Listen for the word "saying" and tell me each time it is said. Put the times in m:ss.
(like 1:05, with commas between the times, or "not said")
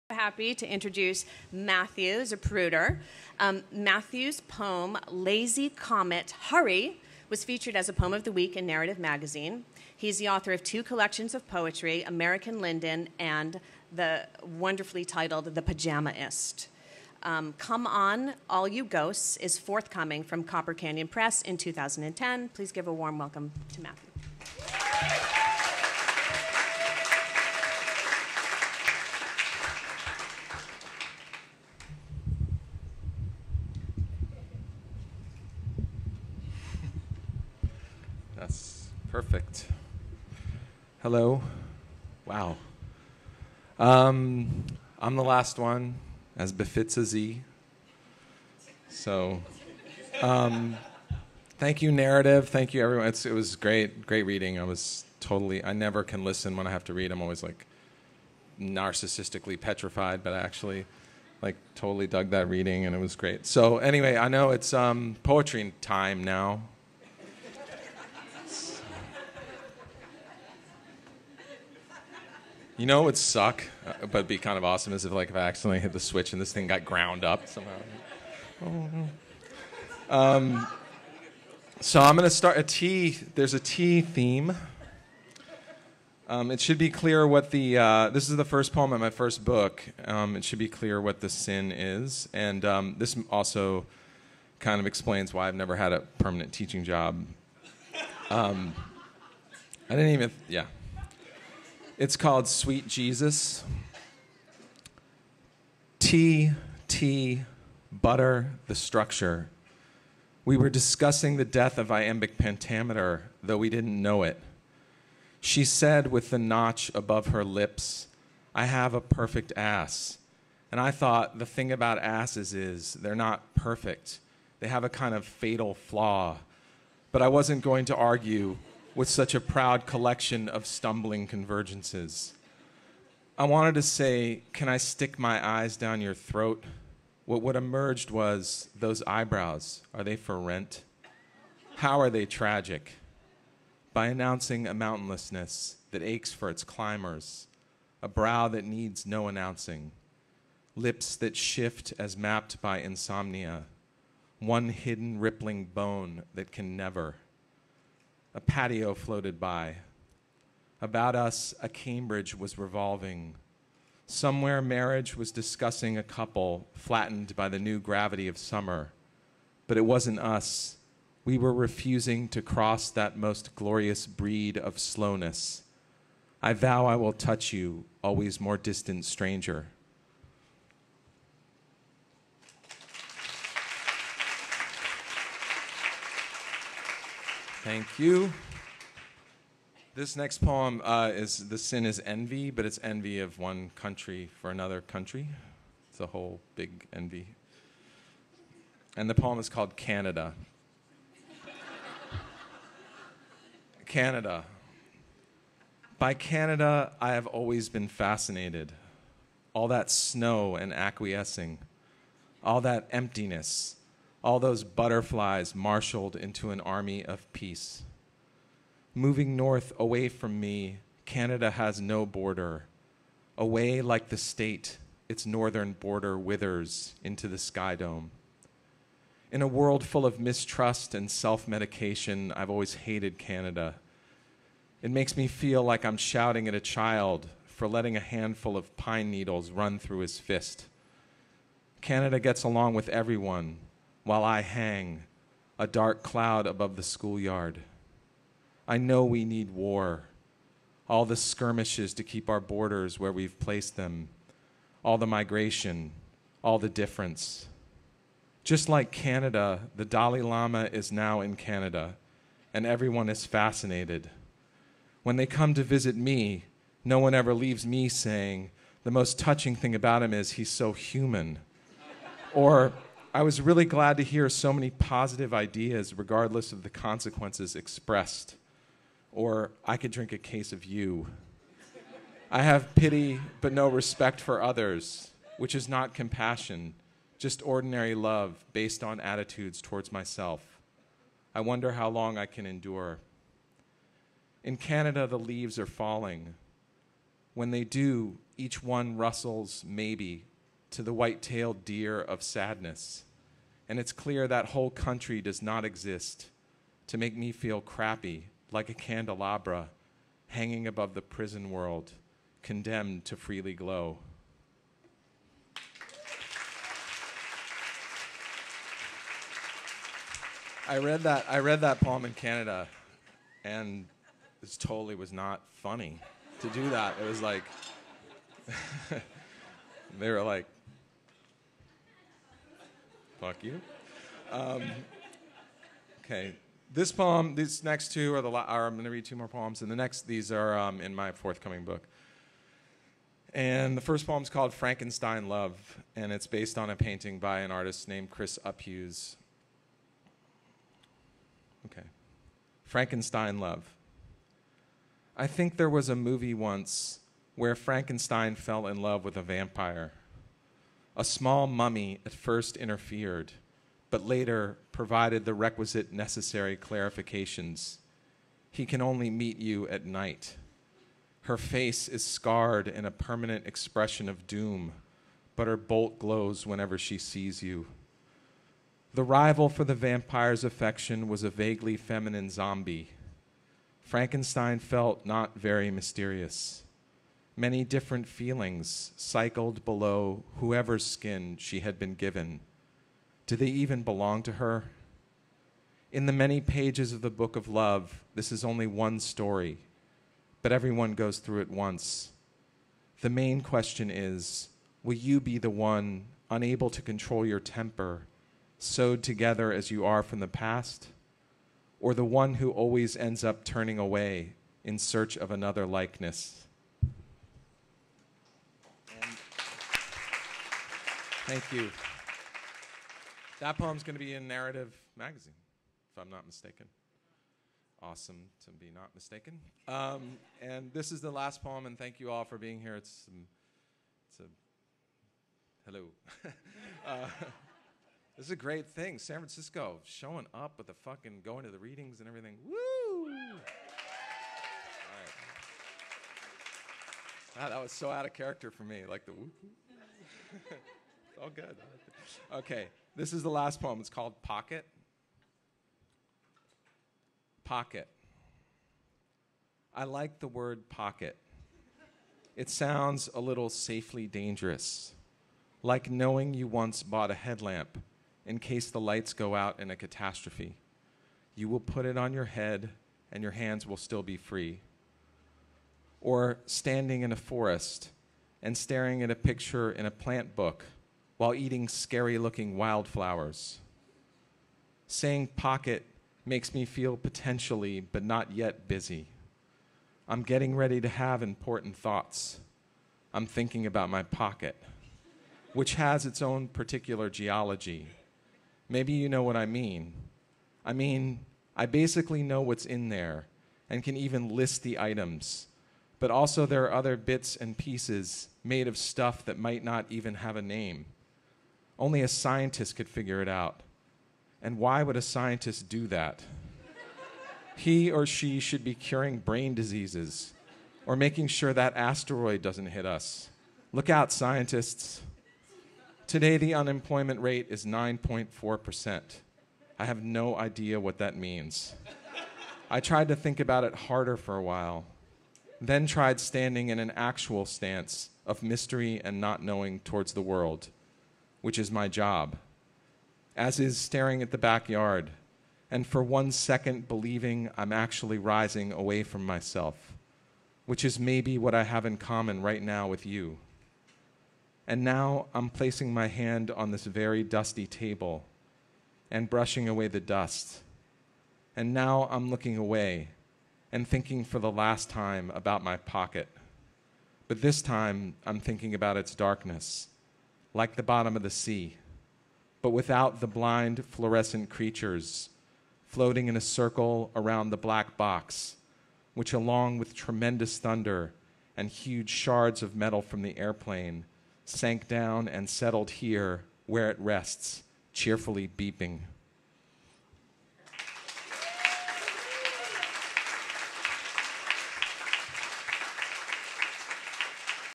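4:27, 8:04.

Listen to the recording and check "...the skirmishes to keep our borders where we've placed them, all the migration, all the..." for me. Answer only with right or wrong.
right.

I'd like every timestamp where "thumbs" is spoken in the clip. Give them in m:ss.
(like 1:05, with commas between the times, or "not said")
not said.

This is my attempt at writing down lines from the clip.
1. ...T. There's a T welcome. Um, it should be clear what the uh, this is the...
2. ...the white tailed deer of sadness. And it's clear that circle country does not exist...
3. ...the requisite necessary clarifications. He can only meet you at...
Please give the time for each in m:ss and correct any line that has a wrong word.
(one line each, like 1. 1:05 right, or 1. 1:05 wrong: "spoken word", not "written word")
1. 1:22 wrong: "theme", not "welcome"
2. 5:00 wrong: "whole", not "circle"
3. 6:05 right.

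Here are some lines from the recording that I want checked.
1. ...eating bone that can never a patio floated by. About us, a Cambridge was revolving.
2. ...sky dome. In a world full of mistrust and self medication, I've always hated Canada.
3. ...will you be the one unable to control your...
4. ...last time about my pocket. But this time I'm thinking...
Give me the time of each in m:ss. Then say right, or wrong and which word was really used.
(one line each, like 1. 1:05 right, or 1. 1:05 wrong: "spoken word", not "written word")
1. 2:35 wrong: "rippling", not "eating"
2. 3:47 right
3. 6:44 right
4. 9:24 right.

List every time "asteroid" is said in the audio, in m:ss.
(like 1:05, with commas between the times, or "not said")
8:41.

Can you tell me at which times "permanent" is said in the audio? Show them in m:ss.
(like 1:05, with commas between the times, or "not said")
1:36, 6:12.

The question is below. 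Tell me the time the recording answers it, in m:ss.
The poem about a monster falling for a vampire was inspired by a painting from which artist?
5:48.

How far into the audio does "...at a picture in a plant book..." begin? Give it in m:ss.
7:59.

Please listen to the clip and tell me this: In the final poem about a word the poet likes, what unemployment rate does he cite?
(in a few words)
9.4%.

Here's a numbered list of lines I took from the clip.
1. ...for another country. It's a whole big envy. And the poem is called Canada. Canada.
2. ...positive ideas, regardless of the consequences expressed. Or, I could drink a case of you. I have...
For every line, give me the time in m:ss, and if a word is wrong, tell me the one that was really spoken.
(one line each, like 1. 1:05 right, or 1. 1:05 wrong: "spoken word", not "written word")
1. 3:14 right
2. 4:34 right.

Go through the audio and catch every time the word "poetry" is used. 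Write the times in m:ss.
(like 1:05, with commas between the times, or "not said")
0:11, 1:05.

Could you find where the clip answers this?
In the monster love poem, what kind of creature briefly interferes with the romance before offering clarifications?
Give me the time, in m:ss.
6:01.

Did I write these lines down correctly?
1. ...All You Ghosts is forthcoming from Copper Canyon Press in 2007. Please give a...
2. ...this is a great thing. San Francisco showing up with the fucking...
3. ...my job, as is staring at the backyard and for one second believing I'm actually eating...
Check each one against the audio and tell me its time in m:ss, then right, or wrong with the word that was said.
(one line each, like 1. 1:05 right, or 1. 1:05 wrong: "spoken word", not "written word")
1. 0:18 wrong: "2010", not "2007"
2. 7:18 right
3. 9:01 wrong: "rising", not "eating".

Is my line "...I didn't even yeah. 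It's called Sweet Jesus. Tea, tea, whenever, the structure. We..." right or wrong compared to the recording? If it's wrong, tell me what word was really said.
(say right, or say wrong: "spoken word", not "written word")
wrong: "butter", not "whenever".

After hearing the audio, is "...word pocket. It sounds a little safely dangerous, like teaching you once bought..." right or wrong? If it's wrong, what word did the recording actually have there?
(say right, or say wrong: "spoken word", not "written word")
wrong: "knowing", not "teaching".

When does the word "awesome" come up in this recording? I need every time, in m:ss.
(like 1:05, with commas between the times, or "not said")
1:14, 7:07.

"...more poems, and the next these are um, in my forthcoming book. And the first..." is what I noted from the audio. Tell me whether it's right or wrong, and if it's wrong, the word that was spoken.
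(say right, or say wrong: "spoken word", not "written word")
right.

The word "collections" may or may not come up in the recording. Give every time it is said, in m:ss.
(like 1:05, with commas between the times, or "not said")
0:10, 2:09.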